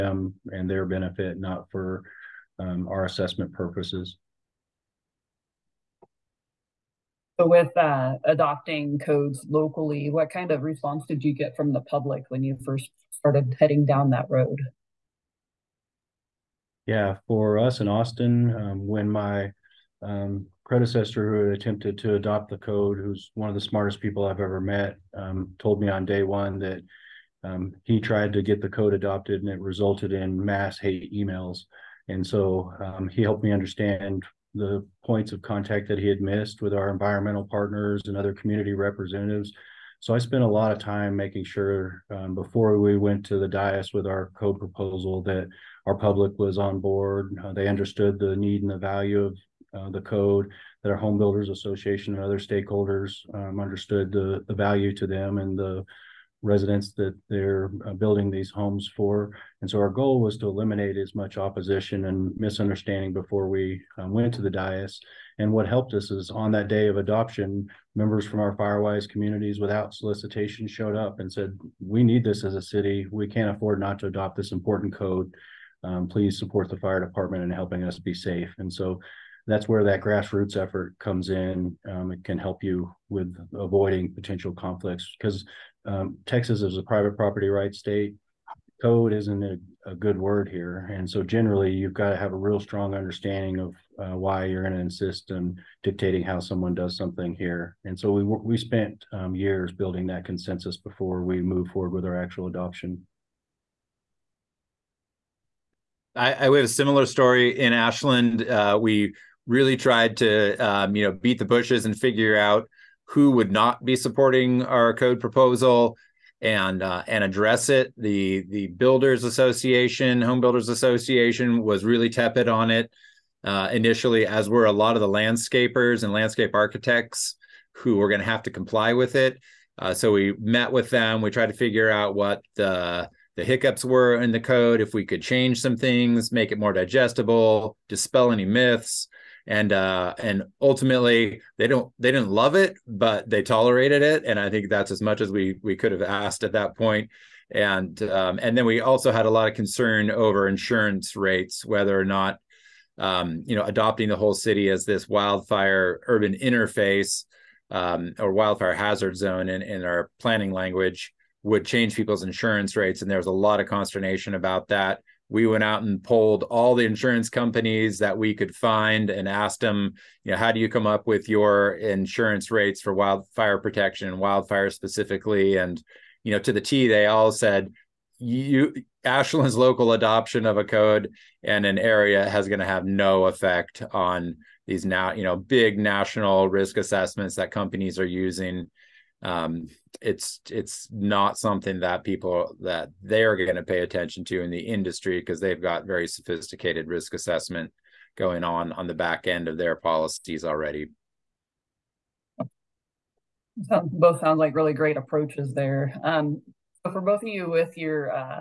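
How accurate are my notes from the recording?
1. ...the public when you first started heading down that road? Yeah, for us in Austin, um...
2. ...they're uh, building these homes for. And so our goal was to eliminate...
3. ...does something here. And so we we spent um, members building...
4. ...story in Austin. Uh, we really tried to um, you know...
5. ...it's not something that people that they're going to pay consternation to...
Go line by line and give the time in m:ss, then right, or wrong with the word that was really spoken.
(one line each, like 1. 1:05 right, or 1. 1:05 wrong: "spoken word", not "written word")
1. 0:11 right
2. 0:57 right
3. 1:36 wrong: "years", not "members"
4. 1:47 wrong: "Ashland", not "Austin"
5. 3:10 wrong: "attention", not "consternation".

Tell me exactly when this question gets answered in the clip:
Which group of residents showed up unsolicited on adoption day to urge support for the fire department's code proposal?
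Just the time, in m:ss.
1:08.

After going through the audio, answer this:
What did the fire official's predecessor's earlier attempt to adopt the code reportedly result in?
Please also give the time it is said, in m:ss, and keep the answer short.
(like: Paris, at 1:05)
mass hate emails, at 0:30.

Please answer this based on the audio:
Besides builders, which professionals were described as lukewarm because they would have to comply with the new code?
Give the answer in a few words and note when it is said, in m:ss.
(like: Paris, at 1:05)
landscapers and landscape architects, at 2:05.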